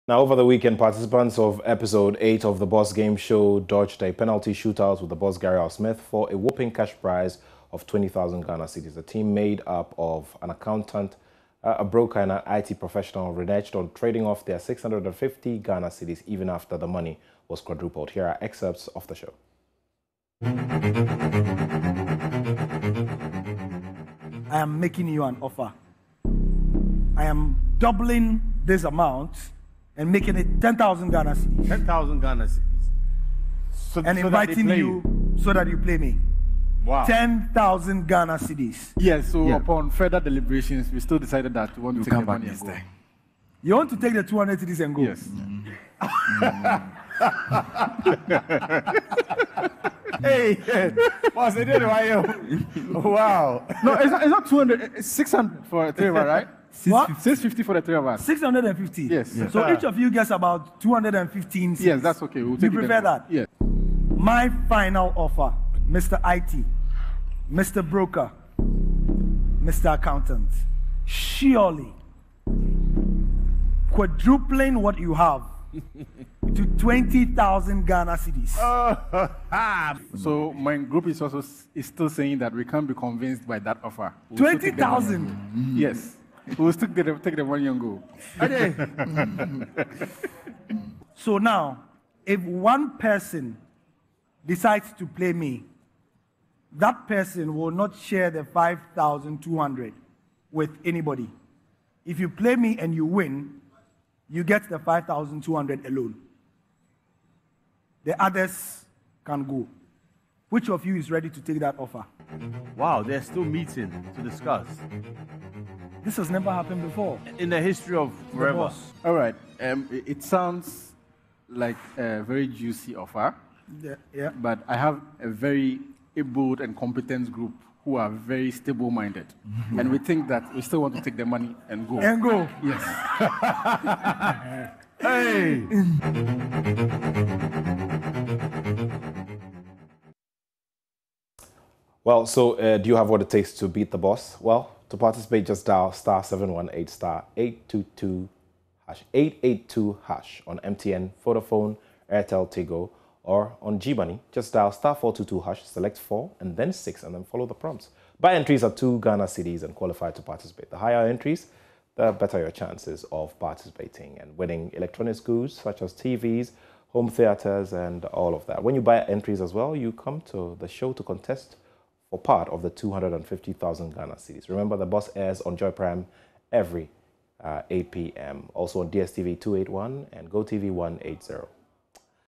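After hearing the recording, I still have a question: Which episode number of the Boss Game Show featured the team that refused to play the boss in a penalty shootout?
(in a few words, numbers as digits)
8.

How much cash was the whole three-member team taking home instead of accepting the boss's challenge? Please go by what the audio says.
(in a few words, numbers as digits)
650 Ghana cedis.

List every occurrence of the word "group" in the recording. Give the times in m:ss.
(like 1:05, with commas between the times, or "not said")
1:20, 2:07.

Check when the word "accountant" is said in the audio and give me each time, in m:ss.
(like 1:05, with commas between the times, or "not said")
0:10, 1:09.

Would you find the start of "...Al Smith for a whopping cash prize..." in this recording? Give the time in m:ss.
0:05.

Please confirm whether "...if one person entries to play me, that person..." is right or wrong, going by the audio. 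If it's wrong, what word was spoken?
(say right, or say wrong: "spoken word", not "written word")
wrong: "decides", not "entries".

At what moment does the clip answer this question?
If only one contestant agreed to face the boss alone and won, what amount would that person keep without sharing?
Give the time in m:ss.
1:44.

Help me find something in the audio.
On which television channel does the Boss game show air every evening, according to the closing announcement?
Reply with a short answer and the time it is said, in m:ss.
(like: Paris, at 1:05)
Joy Prime, at 2:55.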